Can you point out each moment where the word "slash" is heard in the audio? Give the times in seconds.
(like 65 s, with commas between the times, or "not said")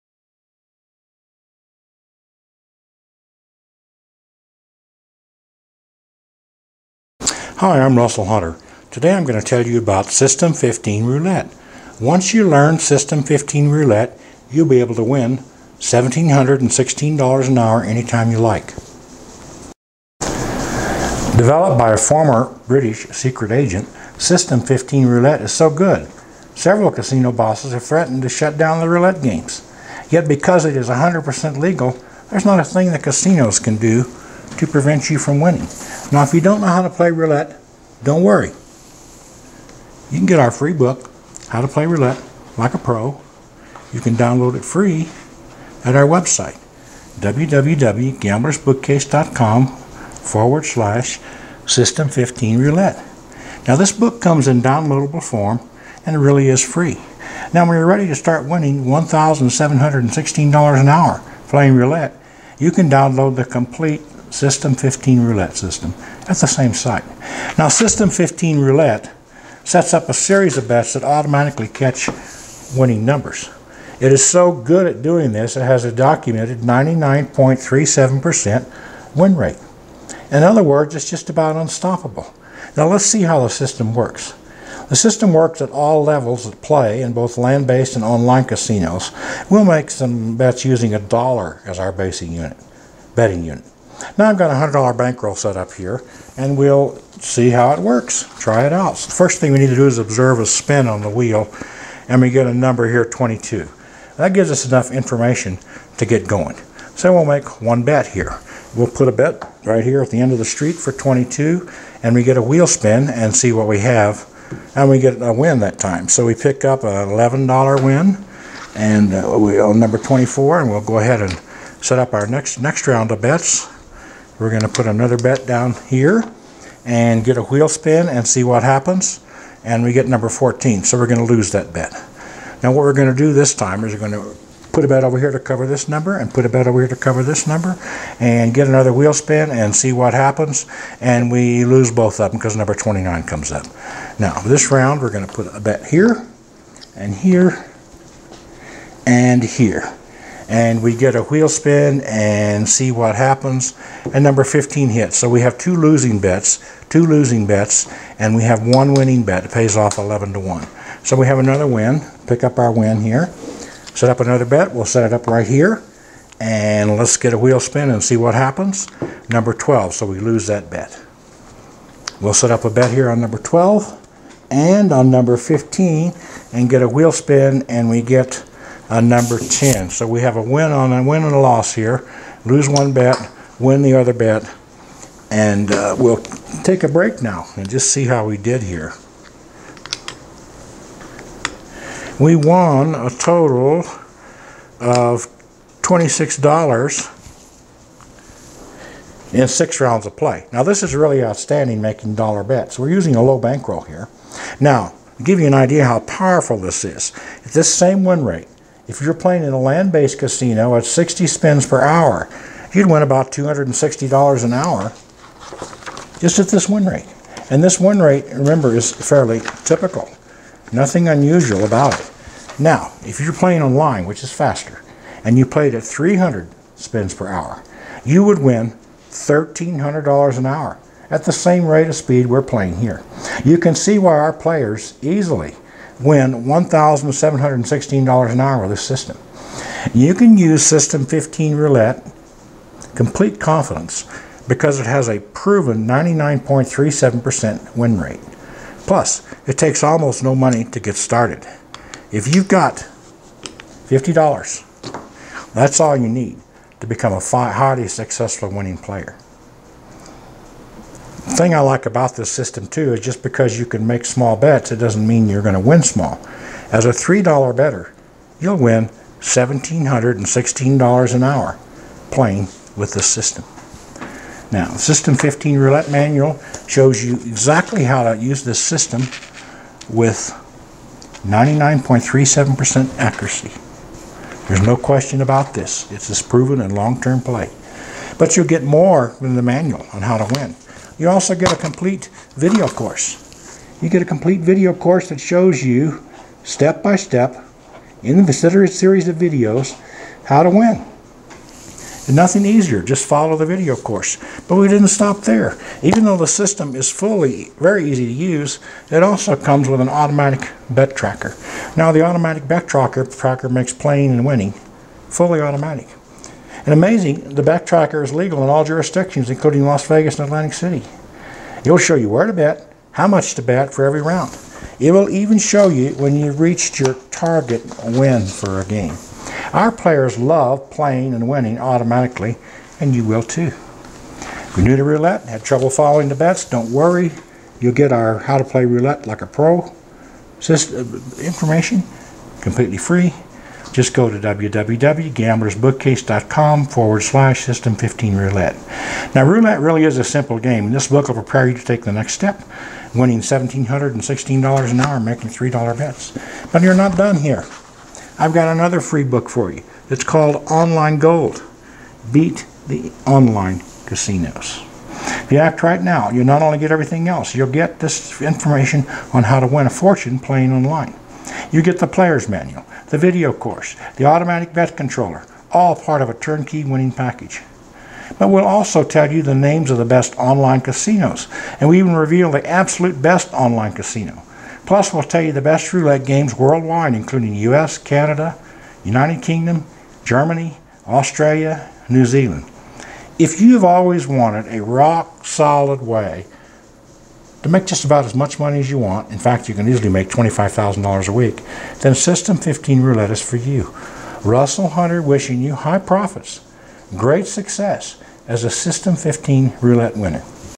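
50 s, 347 s.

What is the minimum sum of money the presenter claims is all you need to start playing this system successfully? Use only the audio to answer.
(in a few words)
$50.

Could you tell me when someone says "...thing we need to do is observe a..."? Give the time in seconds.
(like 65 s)
99 s.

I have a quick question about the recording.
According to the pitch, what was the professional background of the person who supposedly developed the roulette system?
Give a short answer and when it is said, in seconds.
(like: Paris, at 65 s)
Former British secret agent, at 21 s.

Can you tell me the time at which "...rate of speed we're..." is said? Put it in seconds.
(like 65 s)
231 s.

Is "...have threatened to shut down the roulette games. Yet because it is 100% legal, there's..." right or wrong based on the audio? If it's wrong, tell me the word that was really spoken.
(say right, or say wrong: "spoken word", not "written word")
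right.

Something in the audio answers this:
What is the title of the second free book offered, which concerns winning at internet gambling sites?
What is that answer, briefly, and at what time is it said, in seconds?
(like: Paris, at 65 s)
Online Gold Beat the Online Casinos, at 360 s.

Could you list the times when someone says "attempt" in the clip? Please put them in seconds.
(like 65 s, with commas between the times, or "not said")
not said.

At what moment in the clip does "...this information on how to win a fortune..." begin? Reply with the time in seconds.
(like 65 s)
367 s.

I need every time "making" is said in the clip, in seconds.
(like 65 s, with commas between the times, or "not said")
201 s, 354 s.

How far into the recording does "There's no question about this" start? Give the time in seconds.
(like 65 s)
284 s.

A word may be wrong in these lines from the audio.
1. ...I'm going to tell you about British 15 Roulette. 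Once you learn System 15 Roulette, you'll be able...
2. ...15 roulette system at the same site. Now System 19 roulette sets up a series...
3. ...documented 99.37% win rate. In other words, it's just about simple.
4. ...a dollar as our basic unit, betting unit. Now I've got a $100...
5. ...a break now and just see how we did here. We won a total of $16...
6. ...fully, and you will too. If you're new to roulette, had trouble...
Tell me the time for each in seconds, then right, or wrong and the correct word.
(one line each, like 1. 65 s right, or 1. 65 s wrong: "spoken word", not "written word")
1. 9 s wrong: "System", not "British"
2. 64 s wrong: "15", not "19"
3. 75 s wrong: "unstoppable", not "simple"
4. 90 s right
5. 186 s wrong: "26", not "16"
6. 331 s wrong: "automatically", not "fully".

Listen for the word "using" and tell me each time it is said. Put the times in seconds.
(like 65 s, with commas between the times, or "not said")
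90 s, 202 s.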